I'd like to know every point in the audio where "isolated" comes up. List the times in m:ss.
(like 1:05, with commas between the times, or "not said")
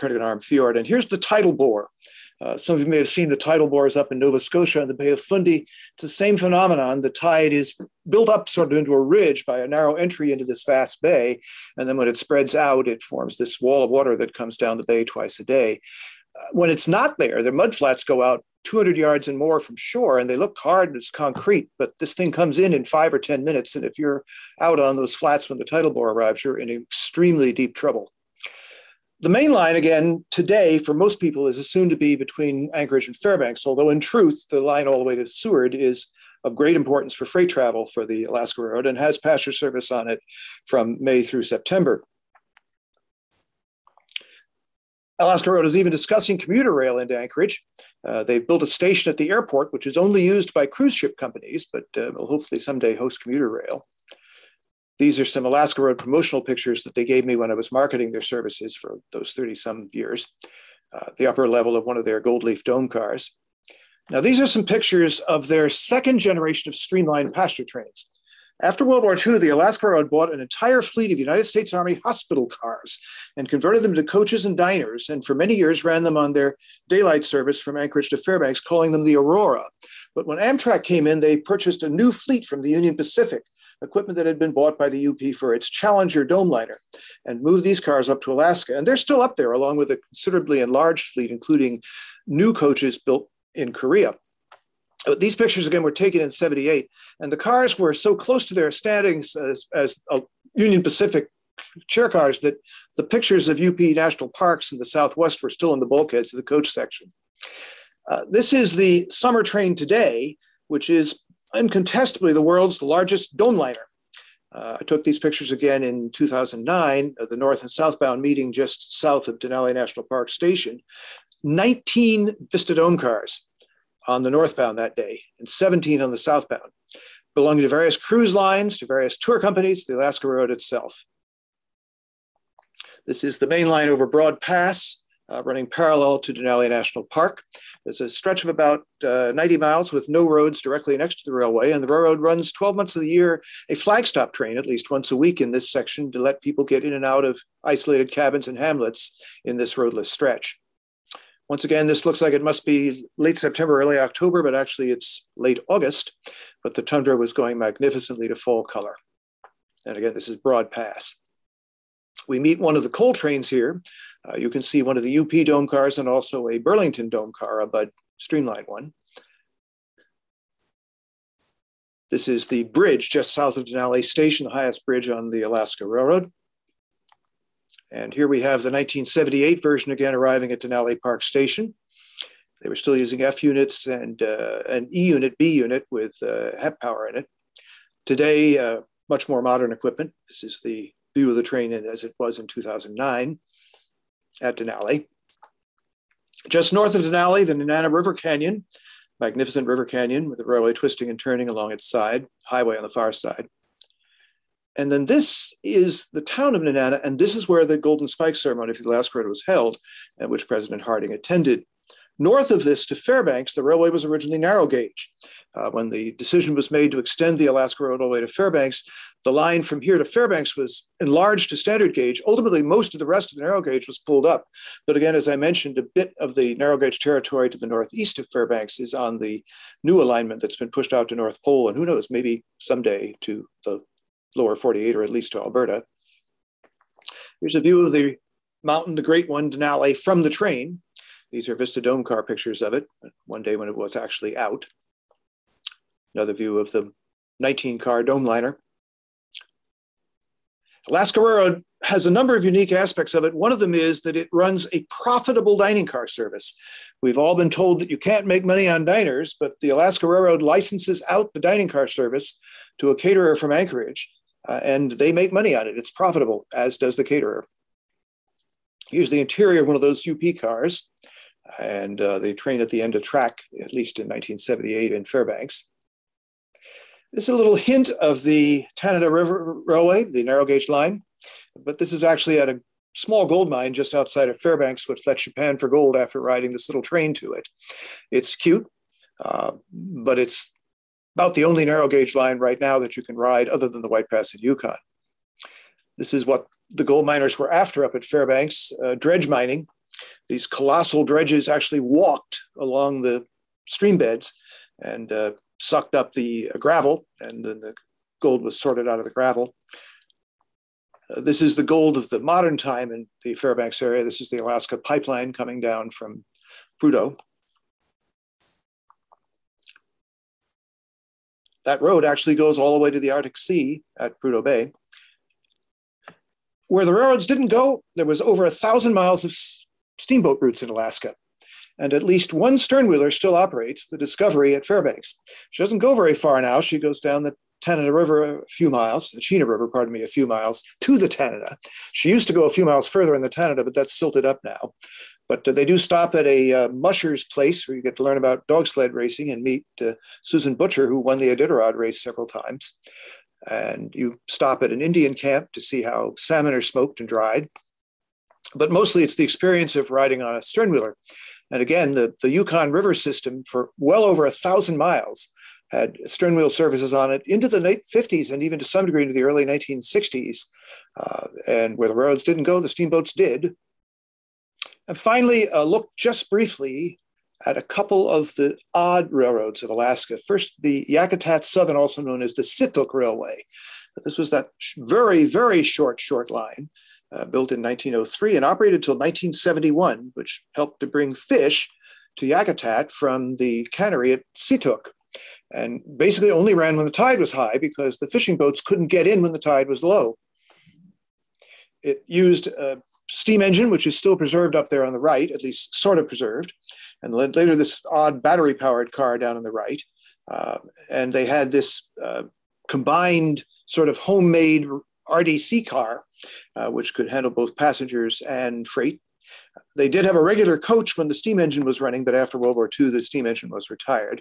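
2:27.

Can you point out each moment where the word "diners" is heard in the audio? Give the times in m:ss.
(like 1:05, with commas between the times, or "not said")
1:14, 4:18.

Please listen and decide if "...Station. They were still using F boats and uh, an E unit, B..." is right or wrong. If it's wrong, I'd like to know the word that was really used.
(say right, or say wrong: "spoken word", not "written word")
wrong: "units", not "boats".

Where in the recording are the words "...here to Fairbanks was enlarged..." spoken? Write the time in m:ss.
3:39.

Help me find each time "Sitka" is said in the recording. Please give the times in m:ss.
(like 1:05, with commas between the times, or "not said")
6:22.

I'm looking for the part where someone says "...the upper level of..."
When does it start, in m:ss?
1:01.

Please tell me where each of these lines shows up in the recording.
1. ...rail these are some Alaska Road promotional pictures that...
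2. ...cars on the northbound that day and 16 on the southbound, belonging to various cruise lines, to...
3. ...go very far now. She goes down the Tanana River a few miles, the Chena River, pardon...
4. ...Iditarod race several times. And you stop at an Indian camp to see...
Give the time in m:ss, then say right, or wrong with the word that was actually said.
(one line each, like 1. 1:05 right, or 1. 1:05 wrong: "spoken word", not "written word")
1. 0:53 right
2. 2:02 wrong: "17", not "16"
3. 5:35 right
4. 5:51 right.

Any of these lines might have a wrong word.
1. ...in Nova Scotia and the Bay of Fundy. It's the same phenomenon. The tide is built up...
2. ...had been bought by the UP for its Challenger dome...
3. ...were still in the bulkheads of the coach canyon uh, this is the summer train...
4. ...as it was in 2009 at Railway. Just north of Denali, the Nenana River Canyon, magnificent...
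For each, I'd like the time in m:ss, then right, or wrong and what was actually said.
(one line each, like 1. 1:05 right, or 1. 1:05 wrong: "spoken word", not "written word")
1. 0:04 right
2. 1:24 right
3. 1:45 wrong: "section", not "canyon"
4. 3:11 wrong: "Denali", not "Railway".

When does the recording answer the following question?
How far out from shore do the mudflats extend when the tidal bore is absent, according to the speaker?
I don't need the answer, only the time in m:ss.
0:18.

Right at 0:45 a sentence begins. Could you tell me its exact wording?
Alaska Road is even discussing commuter rail into Anchorage.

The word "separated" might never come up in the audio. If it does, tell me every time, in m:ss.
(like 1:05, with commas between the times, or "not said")
not said.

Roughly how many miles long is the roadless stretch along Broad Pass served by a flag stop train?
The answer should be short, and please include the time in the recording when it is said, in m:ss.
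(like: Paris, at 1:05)
90 miles, at 2:19.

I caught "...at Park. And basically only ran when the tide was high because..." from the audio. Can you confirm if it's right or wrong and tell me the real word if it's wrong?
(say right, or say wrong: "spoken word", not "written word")
wrong: "Situk", not "Park".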